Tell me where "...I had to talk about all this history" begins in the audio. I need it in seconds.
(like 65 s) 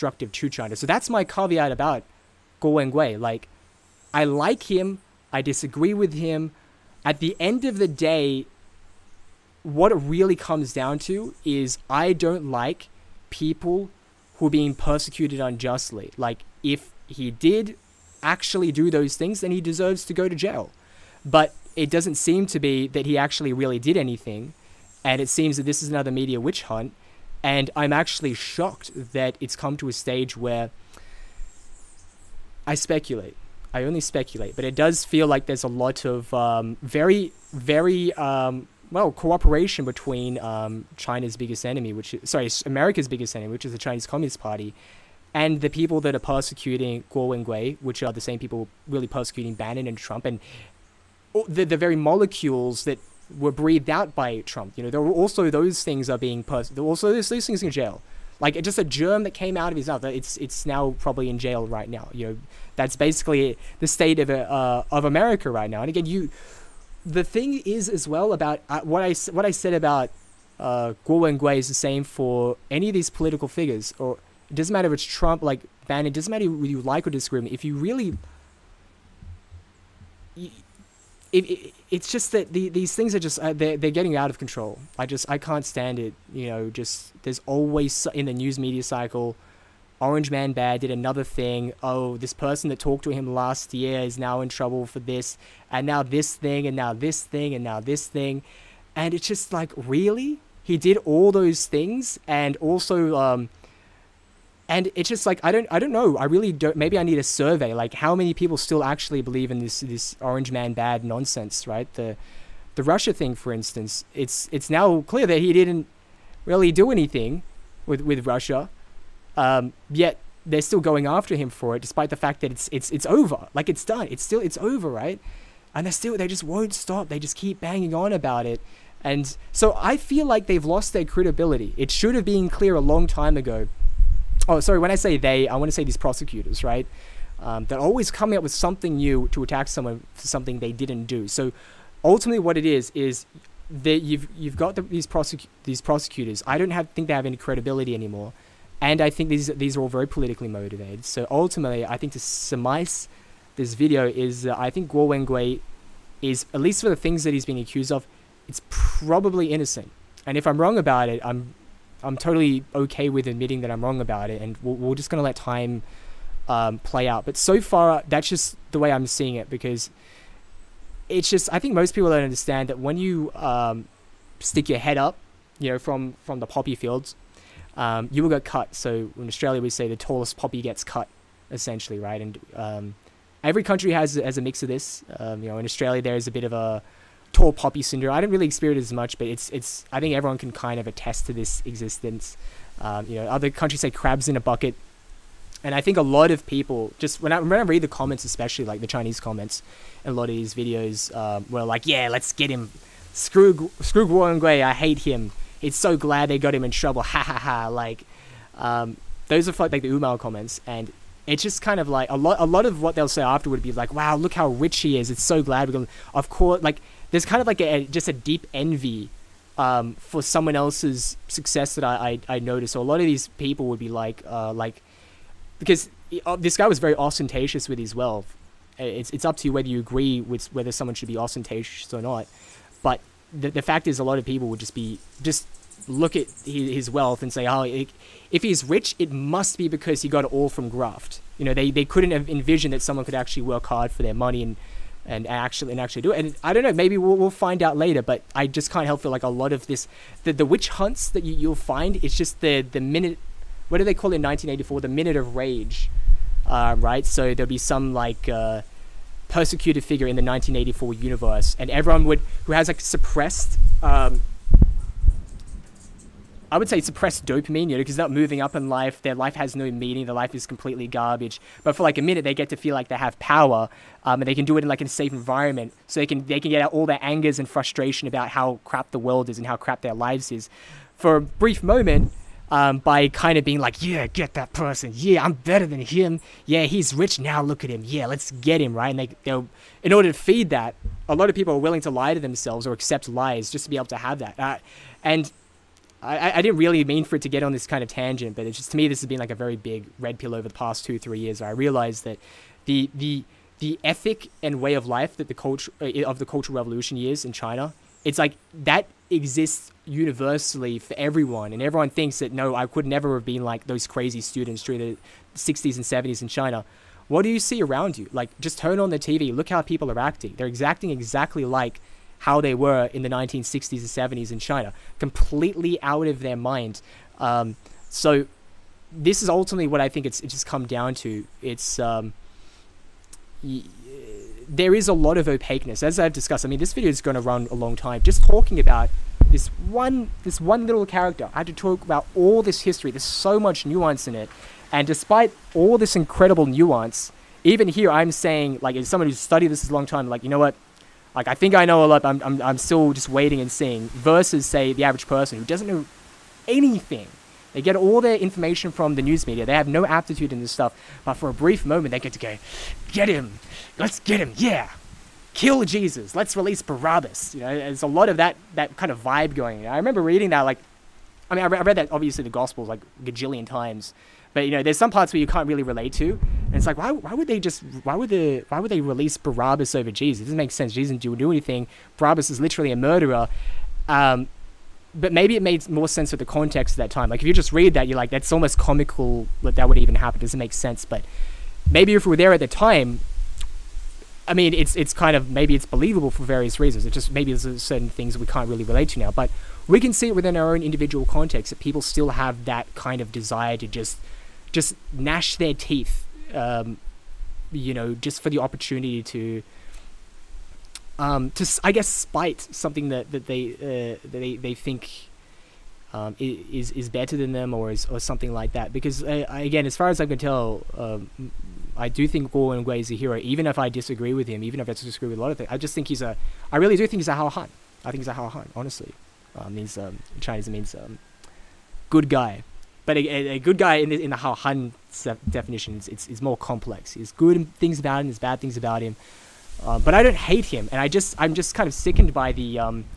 341 s.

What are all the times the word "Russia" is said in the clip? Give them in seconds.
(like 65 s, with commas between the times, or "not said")
112 s, 118 s.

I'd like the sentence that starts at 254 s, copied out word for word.
The minute of rage, uh, right?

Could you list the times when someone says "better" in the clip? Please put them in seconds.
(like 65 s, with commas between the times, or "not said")
285 s, 416 s.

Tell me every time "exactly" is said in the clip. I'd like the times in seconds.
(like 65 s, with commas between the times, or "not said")
320 s.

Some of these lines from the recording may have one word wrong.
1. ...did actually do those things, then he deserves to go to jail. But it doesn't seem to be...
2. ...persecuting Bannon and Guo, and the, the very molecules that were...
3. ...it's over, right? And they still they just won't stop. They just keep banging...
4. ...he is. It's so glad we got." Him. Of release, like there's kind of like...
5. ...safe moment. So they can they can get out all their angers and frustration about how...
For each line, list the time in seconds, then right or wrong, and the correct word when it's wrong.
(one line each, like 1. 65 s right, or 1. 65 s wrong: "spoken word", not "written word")
1. 17 s right
2. 49 s wrong: "Trump", not "Guo"
3. 124 s right
4. 214 s wrong: "course", not "release"
5. 274 s wrong: "environment", not "moment".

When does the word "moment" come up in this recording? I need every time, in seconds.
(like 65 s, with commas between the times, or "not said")
281 s, 361 s.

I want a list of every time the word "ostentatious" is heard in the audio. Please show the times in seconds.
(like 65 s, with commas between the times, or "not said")
226 s, 231 s.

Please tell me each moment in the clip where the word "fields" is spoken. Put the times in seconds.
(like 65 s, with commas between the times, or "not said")
176 s.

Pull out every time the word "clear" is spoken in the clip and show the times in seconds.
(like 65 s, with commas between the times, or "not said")
115 s, 132 s.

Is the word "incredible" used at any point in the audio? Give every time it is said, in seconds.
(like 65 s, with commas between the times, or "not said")
345 s.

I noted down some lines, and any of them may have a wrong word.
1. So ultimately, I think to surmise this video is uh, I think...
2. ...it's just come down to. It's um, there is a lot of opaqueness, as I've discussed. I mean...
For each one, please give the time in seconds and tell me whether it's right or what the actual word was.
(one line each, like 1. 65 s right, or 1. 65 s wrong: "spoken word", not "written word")
1. 151 s right
2. 330 s right.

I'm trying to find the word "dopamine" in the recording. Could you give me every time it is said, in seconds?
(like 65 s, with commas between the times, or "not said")
267 s.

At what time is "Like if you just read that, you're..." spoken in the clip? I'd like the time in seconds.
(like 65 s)
387 s.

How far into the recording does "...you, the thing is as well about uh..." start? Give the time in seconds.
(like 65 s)
66 s.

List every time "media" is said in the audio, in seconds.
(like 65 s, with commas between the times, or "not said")
26 s, 88 s, 359 s.